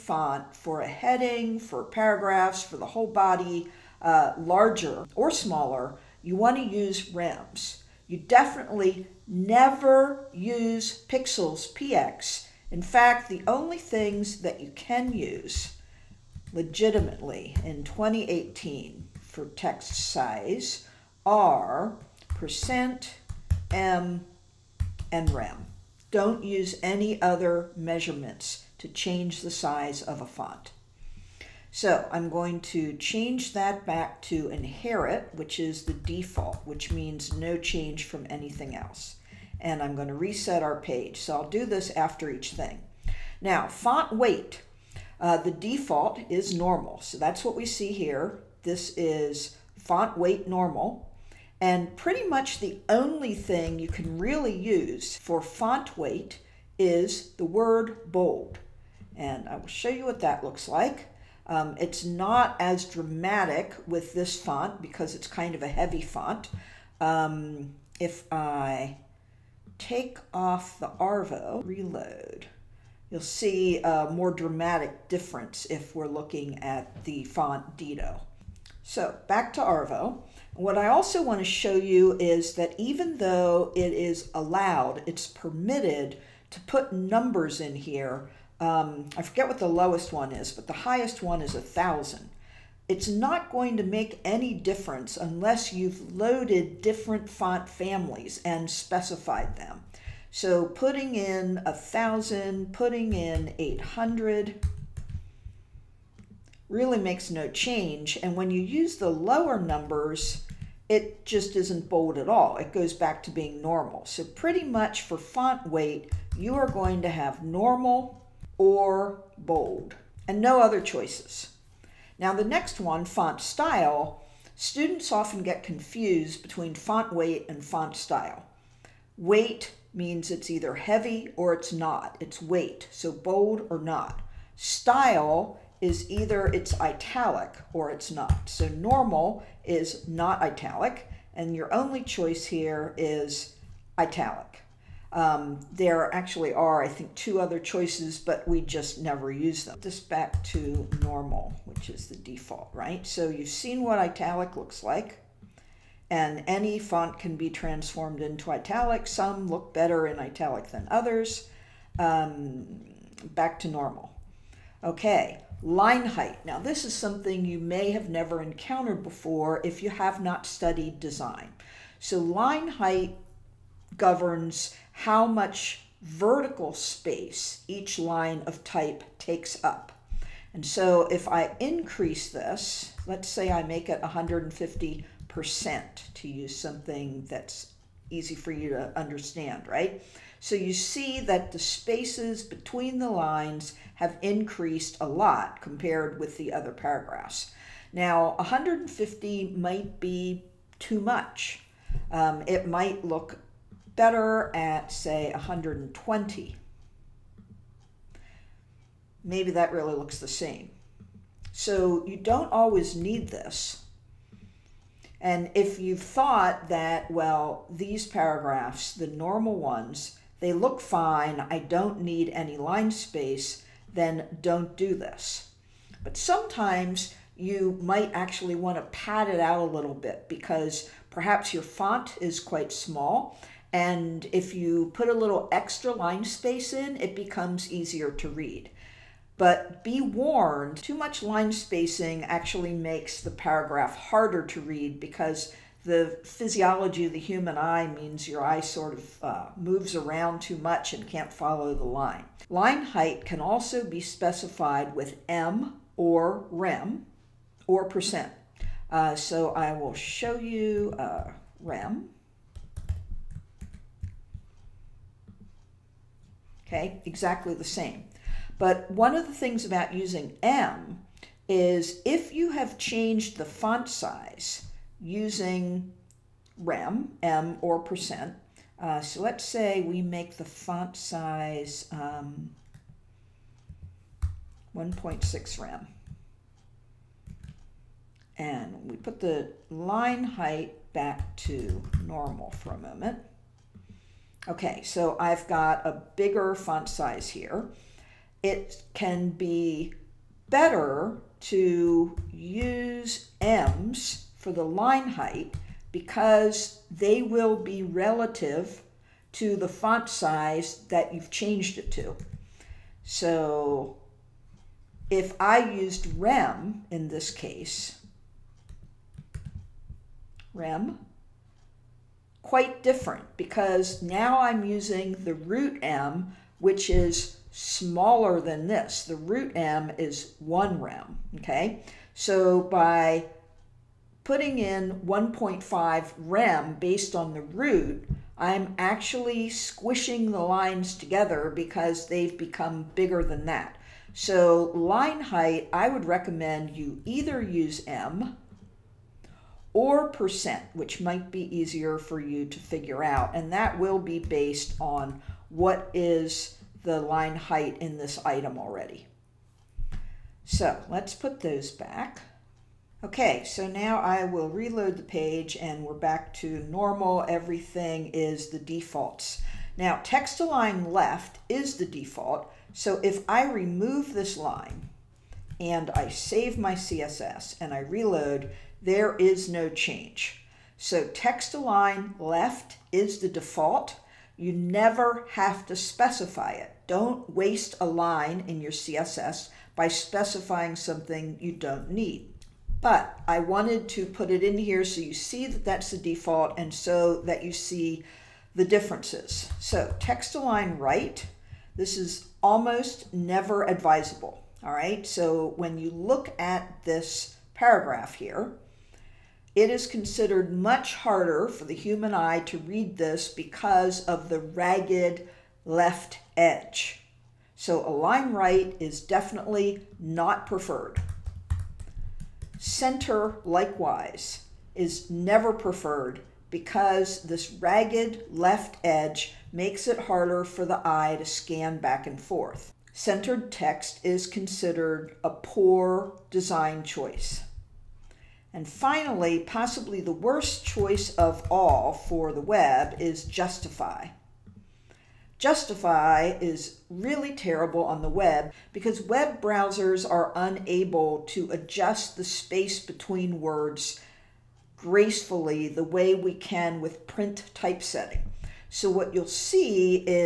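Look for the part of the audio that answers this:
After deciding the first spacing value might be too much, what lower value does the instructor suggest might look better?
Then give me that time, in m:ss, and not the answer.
3:25.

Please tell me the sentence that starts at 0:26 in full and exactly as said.
Don't use any other measurements to change the size of a font.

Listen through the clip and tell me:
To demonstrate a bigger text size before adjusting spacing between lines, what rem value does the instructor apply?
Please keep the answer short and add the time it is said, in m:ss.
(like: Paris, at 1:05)
1.6 rem, at 4:44.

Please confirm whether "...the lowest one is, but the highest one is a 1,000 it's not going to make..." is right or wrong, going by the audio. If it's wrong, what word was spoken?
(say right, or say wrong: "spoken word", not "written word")
right.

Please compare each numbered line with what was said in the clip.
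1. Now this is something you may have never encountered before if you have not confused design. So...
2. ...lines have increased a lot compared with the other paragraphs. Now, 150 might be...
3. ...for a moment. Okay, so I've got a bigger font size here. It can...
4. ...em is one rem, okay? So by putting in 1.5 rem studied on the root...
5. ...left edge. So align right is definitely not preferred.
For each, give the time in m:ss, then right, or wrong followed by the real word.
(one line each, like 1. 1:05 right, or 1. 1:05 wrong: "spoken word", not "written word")
1. 2:46 wrong: "studied", not "confused"
2. 3:13 right
3. 4:52 right
4. 5:29 wrong: "based", not "studied"
5. 6:55 right.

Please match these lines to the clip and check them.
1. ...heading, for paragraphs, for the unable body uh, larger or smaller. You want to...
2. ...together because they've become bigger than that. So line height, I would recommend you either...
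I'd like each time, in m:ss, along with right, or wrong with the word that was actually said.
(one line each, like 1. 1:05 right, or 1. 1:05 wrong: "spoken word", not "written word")
1. 0:00 wrong: "whole", not "unable"
2. 5:40 right.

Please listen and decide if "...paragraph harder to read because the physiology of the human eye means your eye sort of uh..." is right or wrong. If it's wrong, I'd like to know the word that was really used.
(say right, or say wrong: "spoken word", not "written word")
right.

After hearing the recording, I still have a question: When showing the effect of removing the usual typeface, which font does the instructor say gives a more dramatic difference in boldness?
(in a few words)
Dido.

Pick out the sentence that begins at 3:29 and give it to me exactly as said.
Maybe that really looks the same.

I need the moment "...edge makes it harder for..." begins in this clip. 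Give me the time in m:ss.
7:08.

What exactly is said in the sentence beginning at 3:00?
And so if I increase this, let's say I make it 150% to use something that's easy for you to understand, right?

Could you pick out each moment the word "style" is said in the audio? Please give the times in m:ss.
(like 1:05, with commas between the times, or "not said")
2:03, 2:07, 2:14.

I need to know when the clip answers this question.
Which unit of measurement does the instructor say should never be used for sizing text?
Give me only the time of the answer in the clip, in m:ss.
0:11.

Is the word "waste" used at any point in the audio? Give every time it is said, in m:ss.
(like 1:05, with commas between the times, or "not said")
6:27.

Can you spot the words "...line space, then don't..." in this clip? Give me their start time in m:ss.
3:42.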